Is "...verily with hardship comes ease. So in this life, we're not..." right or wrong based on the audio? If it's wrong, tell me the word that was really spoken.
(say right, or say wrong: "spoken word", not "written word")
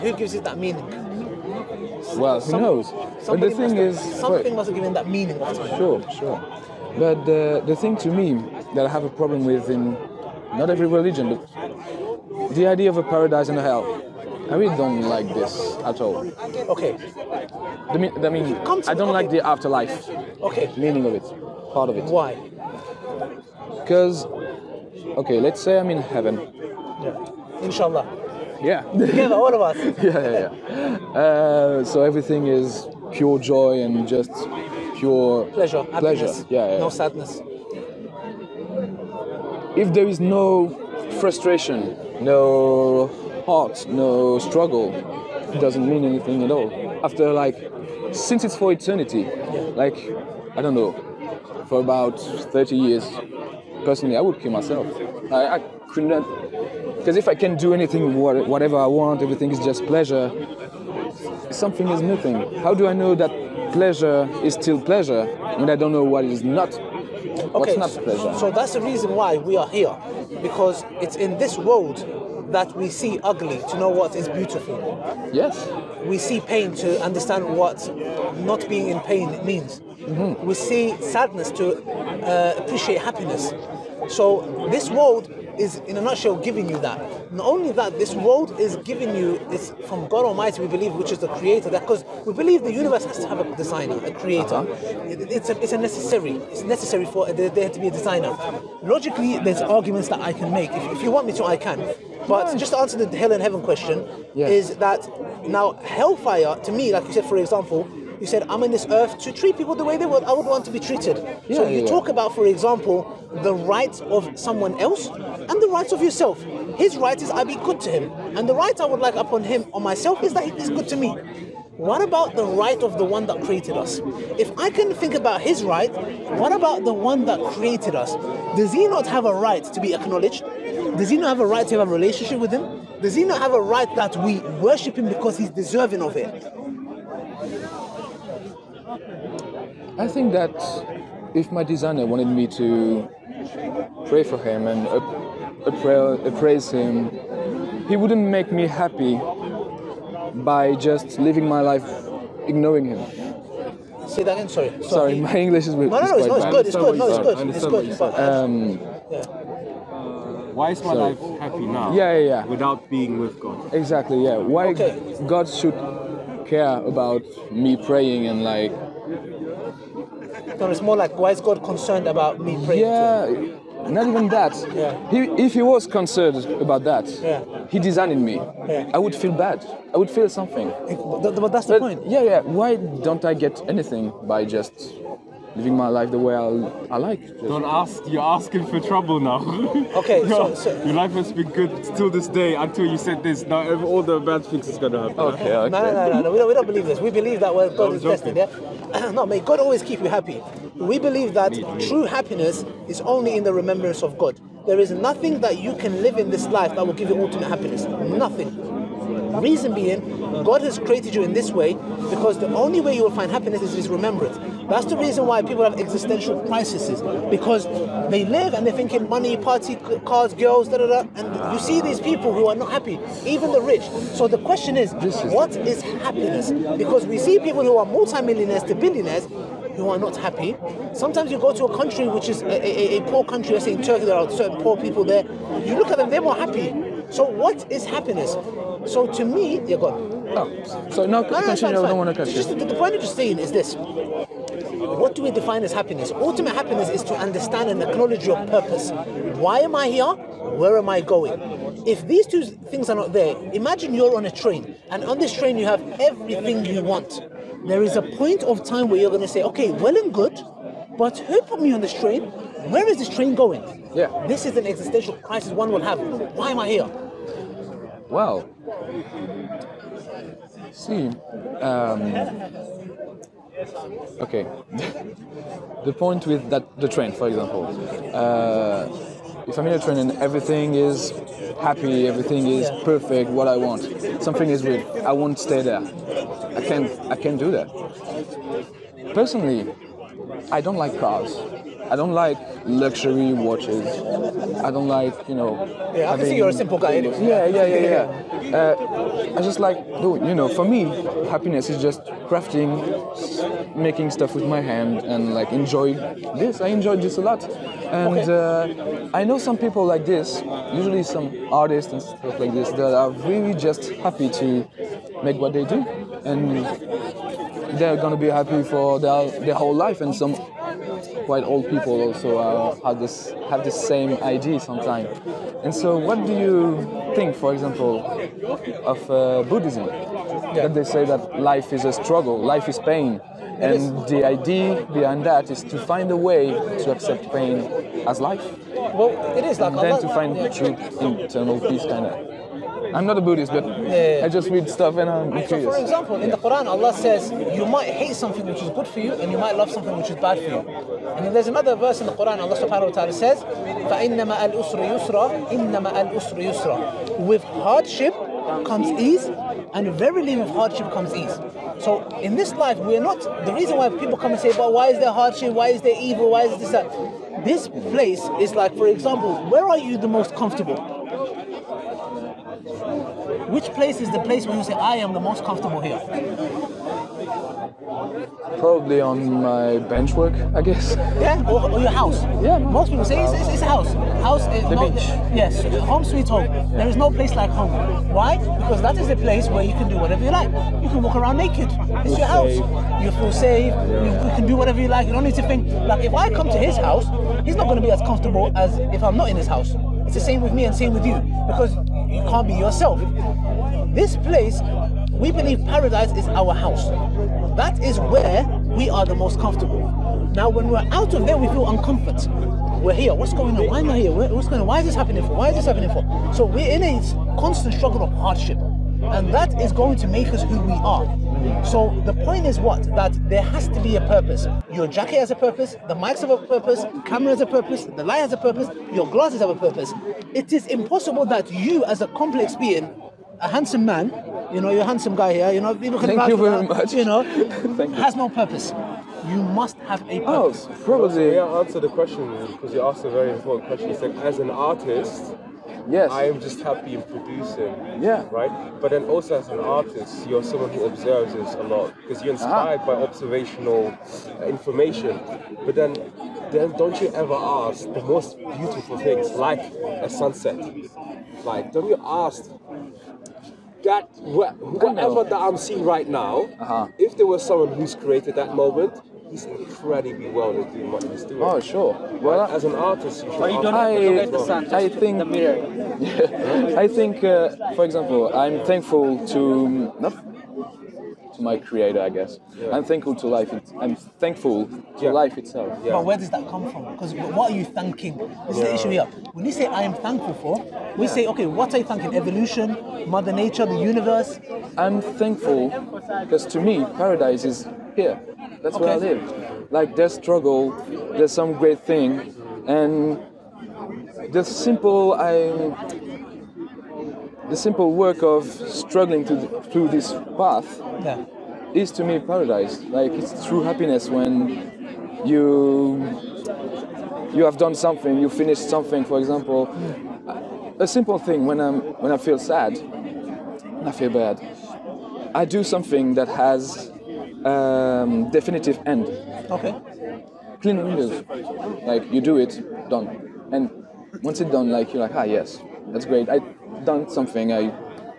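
right.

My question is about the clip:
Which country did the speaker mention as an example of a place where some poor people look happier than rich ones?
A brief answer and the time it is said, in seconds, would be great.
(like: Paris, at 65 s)
Turkey, at 233 s.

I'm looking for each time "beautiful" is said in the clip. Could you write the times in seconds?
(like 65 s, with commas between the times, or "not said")
74 s, 458 s.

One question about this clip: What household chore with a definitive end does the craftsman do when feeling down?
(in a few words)
Clean windows.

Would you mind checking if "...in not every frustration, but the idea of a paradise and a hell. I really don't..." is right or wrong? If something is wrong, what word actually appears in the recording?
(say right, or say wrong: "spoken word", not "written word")
wrong: "religion", not "frustration".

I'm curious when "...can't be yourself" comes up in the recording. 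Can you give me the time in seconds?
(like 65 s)
402 s.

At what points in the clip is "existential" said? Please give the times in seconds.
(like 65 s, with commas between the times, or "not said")
215 s, 264 s.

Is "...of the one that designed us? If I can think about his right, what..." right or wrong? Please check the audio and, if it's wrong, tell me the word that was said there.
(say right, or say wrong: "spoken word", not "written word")
wrong: "created", not "designed".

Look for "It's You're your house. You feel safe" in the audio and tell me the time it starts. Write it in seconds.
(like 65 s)
391 s.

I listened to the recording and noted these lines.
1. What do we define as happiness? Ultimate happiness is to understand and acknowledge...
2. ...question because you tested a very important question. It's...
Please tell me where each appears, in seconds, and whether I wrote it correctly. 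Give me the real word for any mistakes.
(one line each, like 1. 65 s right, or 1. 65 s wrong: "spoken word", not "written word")
1. 243 s right
2. 441 s wrong: "asked", not "tested".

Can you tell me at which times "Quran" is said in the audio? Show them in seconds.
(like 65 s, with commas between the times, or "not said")
346 s, 352 s.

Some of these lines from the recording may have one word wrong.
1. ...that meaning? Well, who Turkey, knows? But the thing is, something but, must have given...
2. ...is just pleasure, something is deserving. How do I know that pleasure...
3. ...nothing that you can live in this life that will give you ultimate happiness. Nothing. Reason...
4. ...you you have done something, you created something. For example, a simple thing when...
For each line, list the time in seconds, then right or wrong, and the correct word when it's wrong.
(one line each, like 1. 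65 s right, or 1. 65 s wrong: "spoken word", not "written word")
1. 0 s wrong: "Some", not "Turkey"
2. 59 s wrong: "nothing", not "deserving"
3. 204 s right
4. 515 s wrong: "finished", not "created".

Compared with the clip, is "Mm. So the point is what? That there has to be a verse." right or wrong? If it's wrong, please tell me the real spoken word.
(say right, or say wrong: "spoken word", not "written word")
wrong: "purpose", not "verse".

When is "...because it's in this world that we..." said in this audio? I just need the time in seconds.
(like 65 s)
70 s.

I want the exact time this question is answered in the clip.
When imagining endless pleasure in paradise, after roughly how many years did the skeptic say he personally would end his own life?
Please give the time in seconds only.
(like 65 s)
51 s.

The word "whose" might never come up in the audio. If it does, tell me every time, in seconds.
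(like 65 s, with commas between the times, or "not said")
not said.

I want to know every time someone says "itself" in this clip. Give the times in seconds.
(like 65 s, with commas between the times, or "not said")
485 s.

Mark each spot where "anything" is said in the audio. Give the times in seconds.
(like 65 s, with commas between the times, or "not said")
46 s, 57 s, 183 s.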